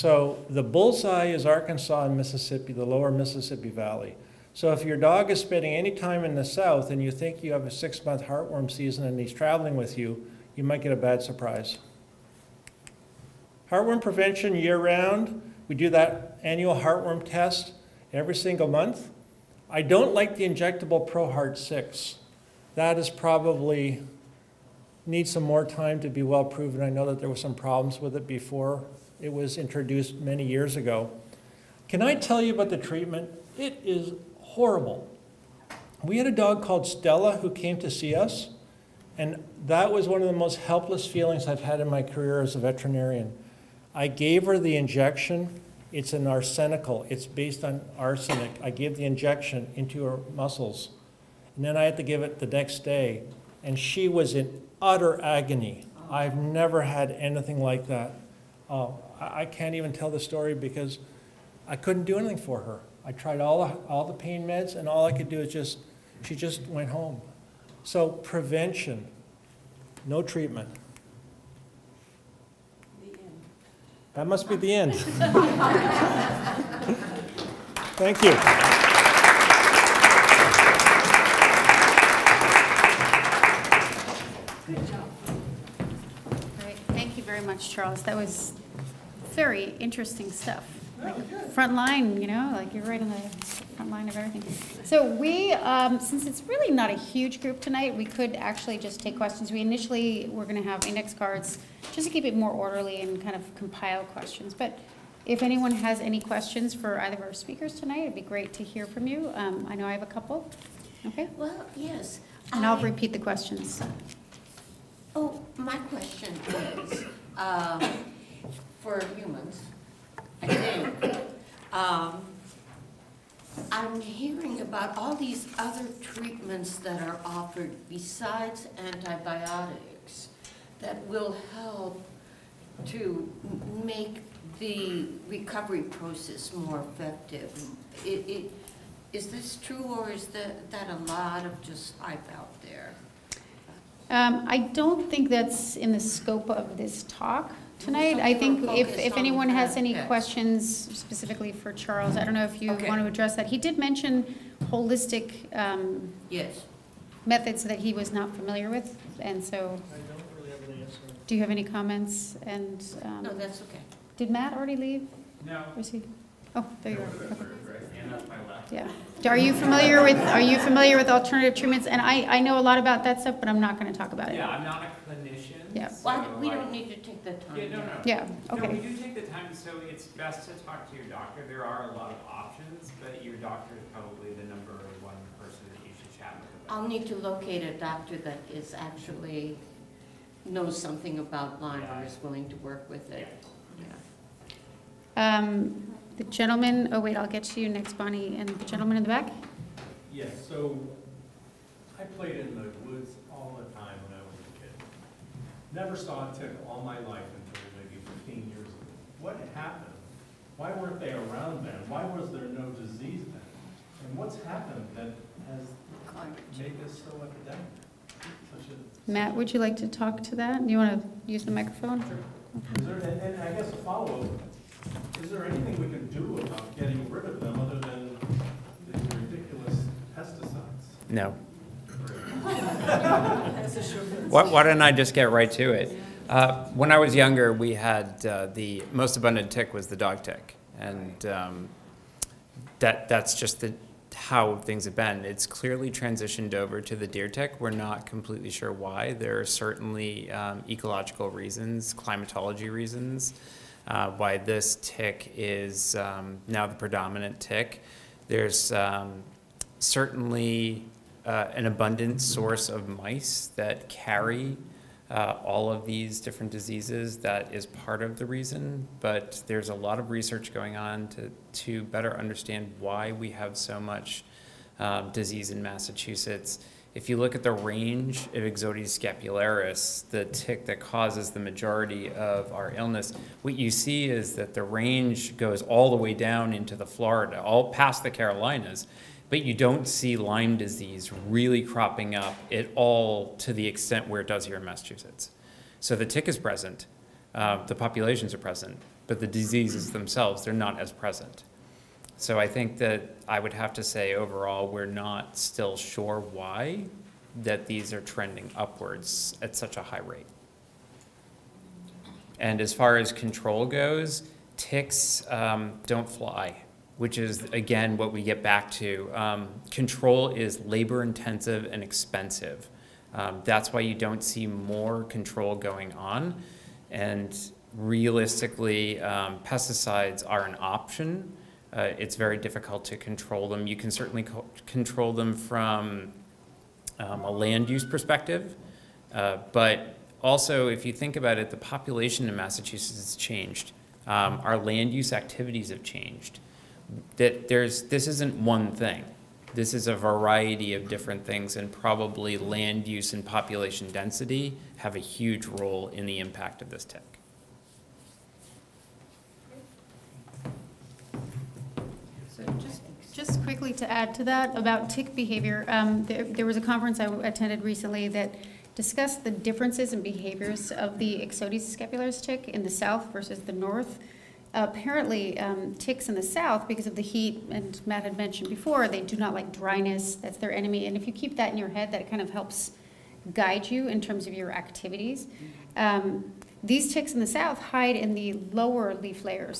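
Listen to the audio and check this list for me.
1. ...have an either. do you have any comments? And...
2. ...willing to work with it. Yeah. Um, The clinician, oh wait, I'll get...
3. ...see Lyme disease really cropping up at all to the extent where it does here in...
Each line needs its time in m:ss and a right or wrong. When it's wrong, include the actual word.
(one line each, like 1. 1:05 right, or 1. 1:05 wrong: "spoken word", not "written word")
1. 2:40 wrong: "answer", not "either"
2. 3:12 wrong: "gentleman", not "clinician"
3. 4:49 right.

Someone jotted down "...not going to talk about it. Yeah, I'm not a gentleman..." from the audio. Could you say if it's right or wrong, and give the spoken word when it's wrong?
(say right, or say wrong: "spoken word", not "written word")
wrong: "clinician", not "gentleman".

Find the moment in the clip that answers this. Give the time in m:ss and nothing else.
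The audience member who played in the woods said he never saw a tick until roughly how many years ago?
3:28.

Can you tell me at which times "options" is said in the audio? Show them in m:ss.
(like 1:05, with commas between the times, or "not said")
3:02, 5:30.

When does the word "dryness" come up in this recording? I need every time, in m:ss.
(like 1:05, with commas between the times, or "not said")
6:19.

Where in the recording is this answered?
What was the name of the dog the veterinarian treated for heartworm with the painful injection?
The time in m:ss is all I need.
0:36.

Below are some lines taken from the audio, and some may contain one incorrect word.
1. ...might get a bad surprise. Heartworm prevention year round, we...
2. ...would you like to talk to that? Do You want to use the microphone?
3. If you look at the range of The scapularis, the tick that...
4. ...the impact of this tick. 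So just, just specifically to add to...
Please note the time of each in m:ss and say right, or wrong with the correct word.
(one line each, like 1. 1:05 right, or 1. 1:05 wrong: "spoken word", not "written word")
1. 0:10 right
2. 3:39 right
3. 4:36 wrong: "Ixodes", not "The"
4. 5:56 wrong: "quickly", not "specifically".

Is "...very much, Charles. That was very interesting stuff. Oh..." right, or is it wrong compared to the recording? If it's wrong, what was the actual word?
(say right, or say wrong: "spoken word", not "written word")
right.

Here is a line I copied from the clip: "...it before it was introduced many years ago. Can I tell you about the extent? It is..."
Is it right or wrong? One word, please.
wrong.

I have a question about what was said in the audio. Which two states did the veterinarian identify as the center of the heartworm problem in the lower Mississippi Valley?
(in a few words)
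Arkansas and Mississippi.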